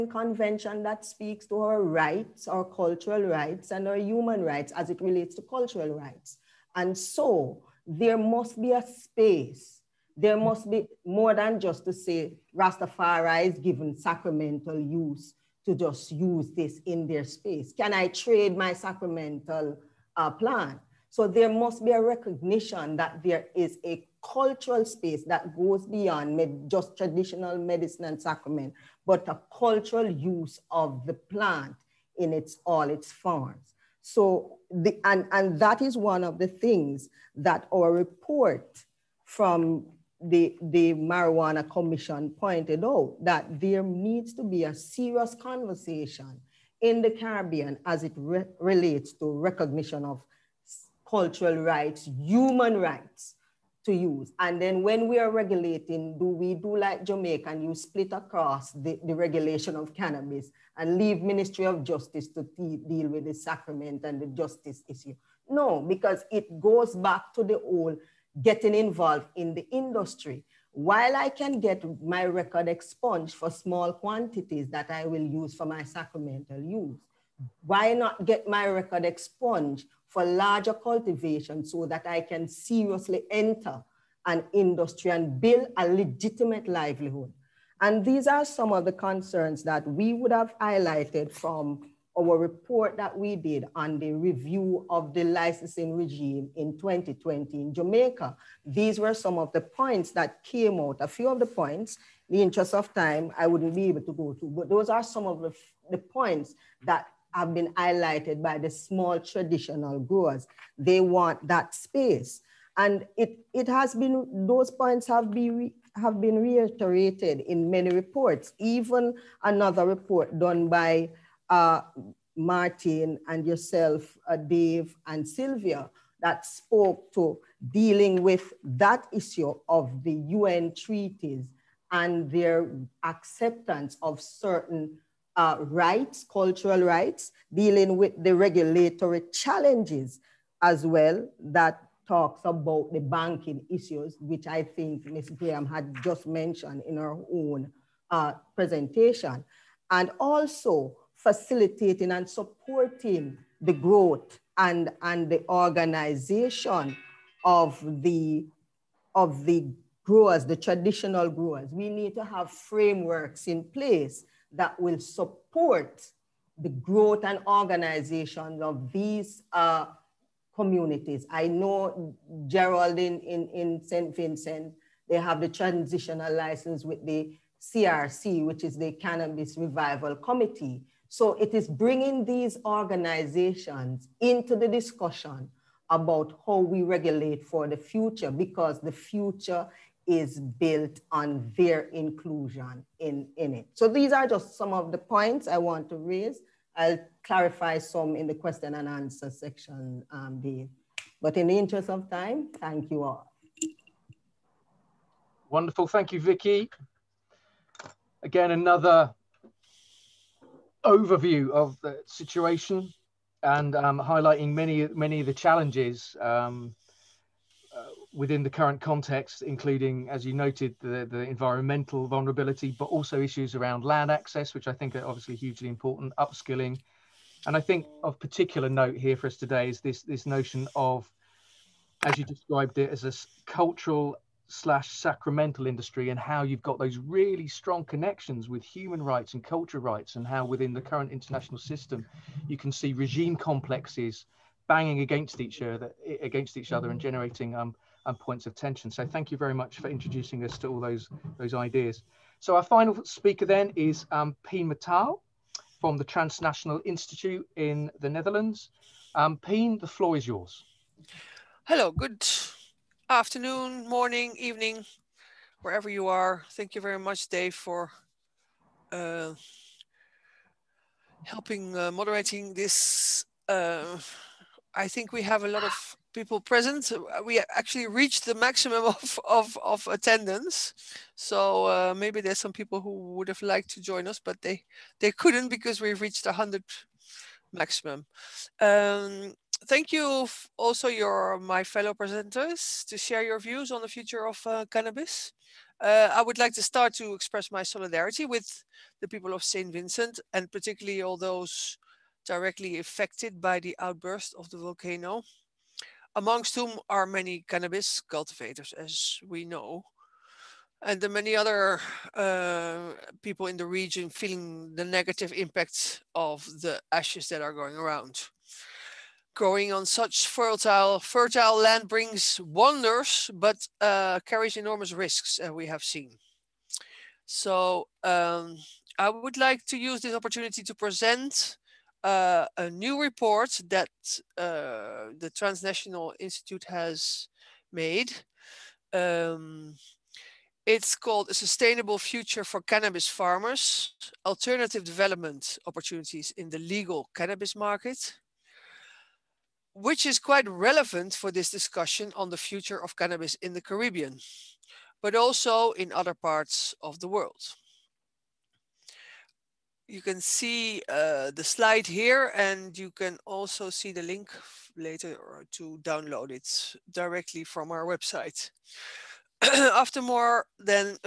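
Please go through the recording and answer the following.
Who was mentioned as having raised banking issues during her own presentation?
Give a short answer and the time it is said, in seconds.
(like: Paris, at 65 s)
Ms. Graham, at 145 s.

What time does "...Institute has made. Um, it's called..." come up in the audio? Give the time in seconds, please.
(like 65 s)
336 s.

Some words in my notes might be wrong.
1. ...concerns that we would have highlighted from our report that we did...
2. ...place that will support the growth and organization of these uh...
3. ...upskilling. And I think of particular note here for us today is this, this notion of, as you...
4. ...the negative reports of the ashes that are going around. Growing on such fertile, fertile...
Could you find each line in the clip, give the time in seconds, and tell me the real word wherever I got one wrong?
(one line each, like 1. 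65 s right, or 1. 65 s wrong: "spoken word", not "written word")
1. 88 s right
2. 163 s right
3. 226 s right
4. 314 s wrong: "impacts", not "reports".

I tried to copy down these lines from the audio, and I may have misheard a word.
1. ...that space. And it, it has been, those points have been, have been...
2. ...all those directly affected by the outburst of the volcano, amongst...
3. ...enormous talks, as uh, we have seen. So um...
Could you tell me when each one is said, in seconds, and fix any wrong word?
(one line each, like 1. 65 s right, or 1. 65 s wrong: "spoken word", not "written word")
1. 111 s right
2. 301 s right
3. 324 s wrong: "risks", not "talks".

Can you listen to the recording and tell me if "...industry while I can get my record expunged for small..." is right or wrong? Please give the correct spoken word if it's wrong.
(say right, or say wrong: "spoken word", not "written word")
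right.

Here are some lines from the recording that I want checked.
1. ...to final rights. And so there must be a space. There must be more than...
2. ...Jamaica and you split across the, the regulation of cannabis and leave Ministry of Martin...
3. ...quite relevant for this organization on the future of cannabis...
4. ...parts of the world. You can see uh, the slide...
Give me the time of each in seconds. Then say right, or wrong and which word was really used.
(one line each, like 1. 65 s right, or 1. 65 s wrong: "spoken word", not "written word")
1. 5 s wrong: "cultural", not "final"
2. 57 s wrong: "Justice", not "Martin"
3. 350 s wrong: "discussion", not "organization"
4. 356 s right.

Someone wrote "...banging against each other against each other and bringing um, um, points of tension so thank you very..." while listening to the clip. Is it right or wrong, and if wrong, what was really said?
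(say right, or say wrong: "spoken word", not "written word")
wrong: "generating", not "bringing".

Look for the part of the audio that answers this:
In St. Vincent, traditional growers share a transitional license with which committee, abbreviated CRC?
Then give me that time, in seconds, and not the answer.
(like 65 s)
178 s.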